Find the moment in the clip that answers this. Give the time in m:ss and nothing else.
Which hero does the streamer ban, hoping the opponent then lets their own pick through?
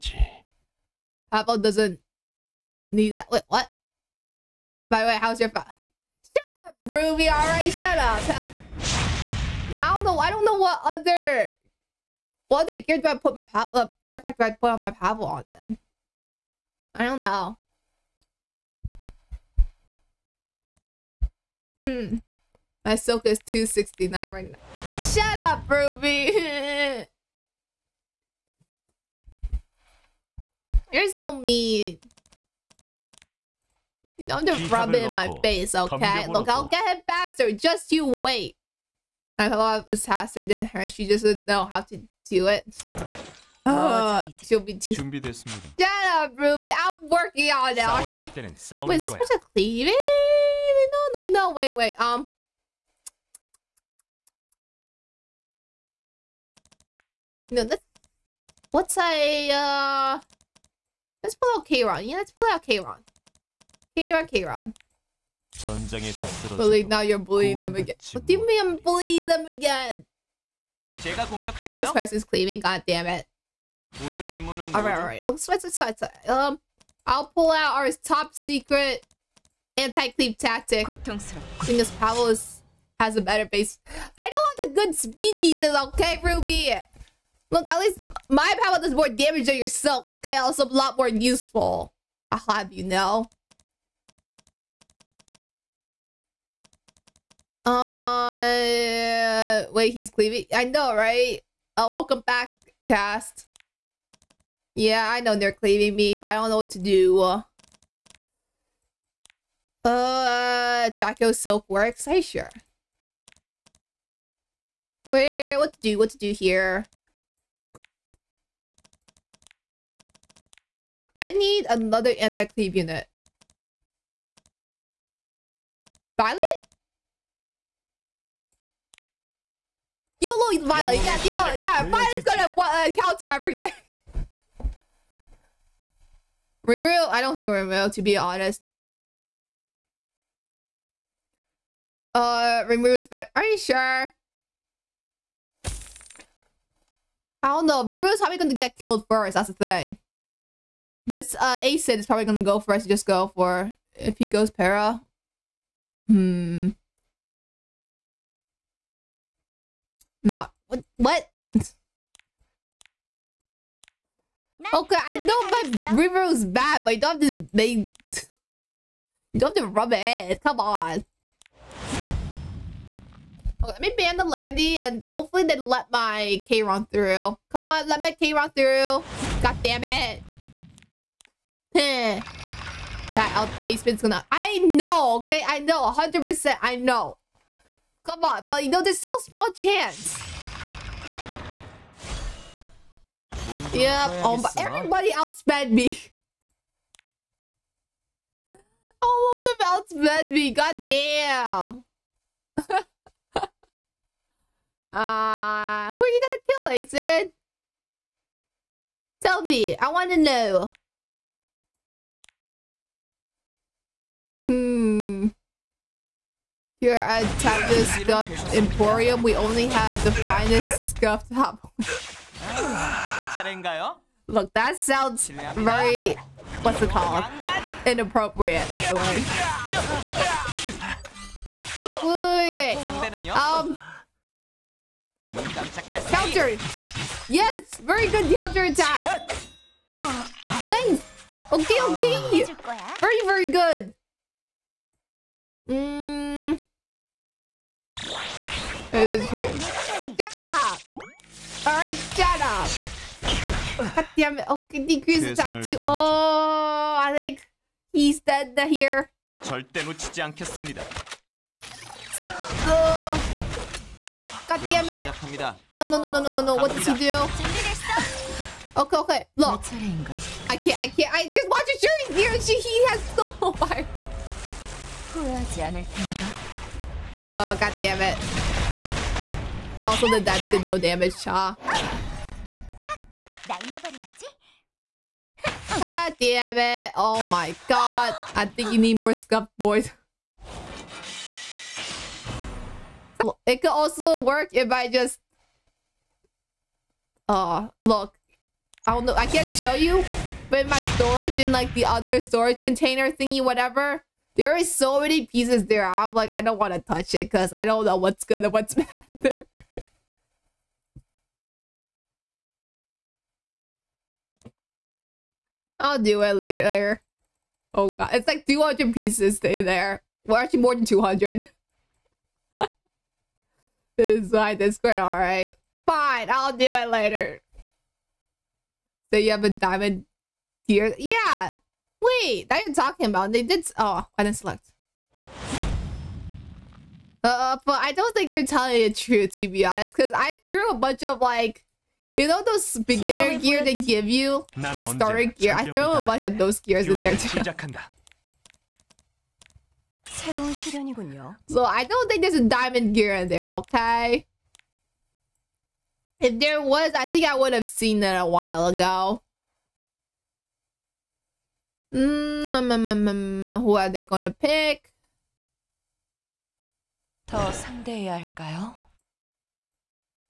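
2:54.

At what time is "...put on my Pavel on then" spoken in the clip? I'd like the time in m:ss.
0:14.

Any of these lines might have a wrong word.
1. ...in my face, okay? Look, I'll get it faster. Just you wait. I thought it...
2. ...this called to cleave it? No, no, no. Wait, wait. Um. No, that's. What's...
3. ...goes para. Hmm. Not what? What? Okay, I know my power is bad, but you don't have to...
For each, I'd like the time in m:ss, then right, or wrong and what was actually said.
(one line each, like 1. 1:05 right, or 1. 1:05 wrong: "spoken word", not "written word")
1. 0:35 right
2. 0:49 wrong: "supposed", not "called"
3. 2:34 wrong: "river", not "power".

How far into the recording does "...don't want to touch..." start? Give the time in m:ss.
5:06.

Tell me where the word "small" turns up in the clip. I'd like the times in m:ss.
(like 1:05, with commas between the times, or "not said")
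3:09.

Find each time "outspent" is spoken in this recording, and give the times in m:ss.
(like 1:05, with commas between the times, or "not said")
3:15, 3:20.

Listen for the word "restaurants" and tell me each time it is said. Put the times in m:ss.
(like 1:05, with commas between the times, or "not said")
not said.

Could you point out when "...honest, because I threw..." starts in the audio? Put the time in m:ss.
5:39.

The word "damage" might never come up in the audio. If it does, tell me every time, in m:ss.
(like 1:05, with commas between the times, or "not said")
1:29, 4:40.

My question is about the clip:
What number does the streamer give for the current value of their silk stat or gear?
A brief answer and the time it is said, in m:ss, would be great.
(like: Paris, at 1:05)
269, at 0:23.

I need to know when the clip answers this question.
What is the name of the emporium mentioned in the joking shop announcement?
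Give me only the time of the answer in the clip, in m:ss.
3:37.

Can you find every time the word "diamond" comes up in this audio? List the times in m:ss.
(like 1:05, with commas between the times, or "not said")
5:29, 5:52.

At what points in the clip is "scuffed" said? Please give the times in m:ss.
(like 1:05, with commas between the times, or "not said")
3:40, 4:49.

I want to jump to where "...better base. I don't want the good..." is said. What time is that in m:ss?
1:23.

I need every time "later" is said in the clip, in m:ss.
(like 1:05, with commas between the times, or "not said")
5:16, 5:26.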